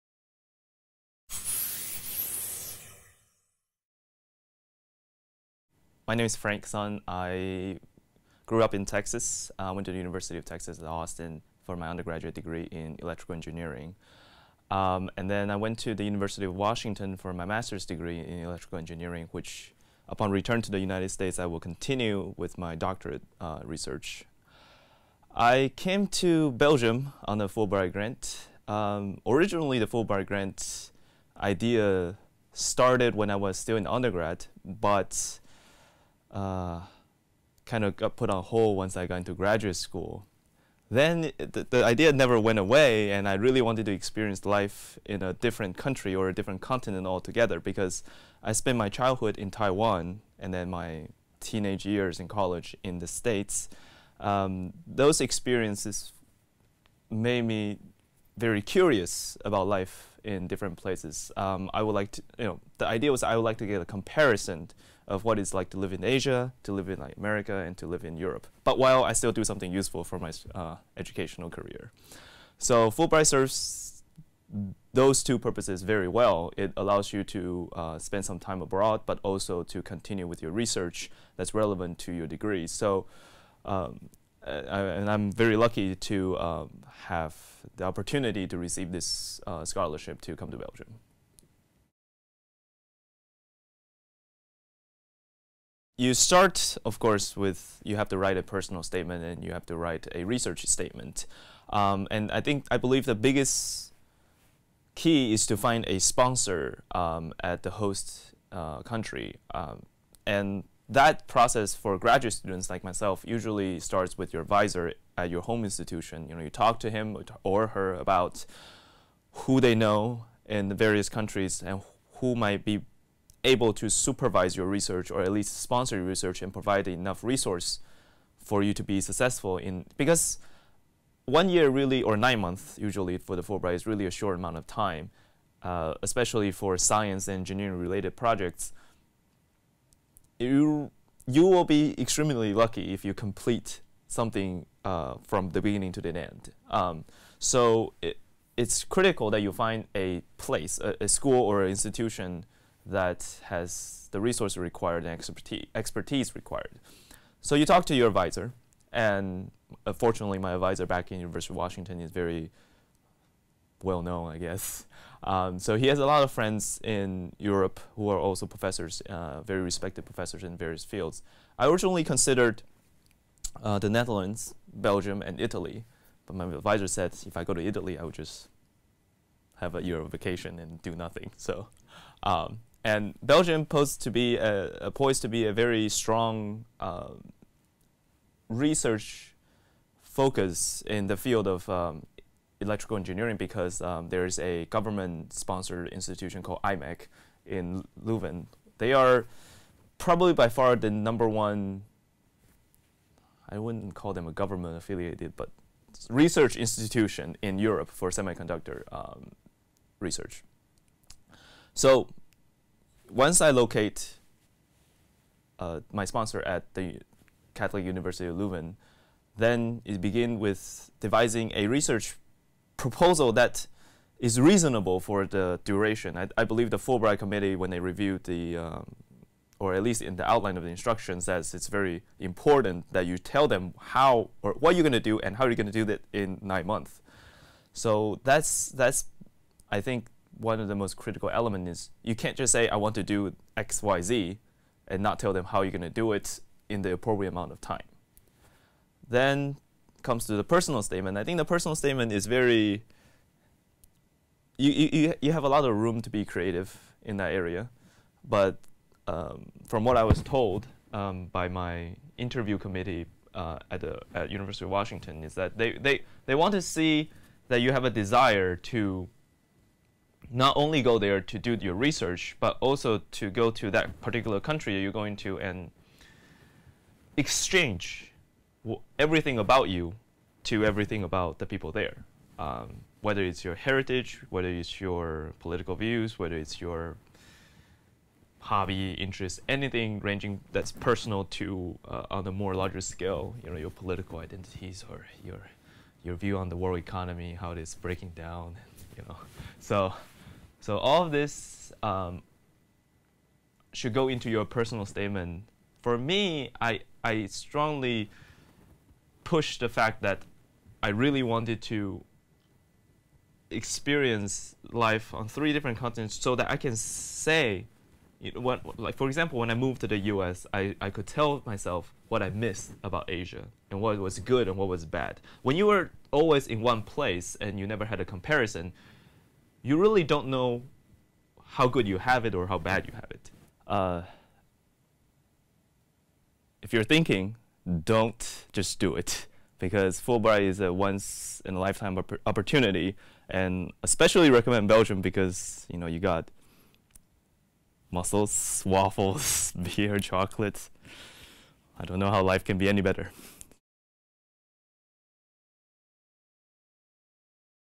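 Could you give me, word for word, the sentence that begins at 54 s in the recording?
Um, those experiences made me very curious about life in different places.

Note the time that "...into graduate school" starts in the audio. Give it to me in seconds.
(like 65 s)
39 s.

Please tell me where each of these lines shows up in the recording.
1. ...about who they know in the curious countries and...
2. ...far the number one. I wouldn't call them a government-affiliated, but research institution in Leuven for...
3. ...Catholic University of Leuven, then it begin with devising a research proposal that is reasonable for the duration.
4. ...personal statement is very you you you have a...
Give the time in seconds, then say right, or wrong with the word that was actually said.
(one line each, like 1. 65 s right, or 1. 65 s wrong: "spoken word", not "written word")
1. 117 s wrong: "various", not "curious"
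2. 200 s wrong: "Europe", not "Leuven"
3. 217 s right
4. 251 s right.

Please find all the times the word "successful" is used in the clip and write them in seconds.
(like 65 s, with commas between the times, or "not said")
129 s.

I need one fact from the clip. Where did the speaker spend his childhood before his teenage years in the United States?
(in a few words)
Taiwan.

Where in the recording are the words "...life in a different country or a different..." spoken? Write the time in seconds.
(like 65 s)
44 s.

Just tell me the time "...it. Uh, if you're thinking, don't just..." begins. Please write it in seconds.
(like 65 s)
333 s.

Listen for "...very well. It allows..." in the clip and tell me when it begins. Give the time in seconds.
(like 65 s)
75 s.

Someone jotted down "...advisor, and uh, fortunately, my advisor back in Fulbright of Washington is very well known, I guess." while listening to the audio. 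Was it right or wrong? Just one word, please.
wrong.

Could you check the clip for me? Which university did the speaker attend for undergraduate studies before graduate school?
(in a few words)
University of Texas at Austin.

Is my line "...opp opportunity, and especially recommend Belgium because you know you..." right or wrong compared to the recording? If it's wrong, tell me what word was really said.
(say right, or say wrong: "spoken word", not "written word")
right.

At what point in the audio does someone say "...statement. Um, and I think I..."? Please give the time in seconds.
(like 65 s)
100 s.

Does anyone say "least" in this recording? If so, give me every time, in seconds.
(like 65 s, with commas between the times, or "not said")
125 s, 229 s.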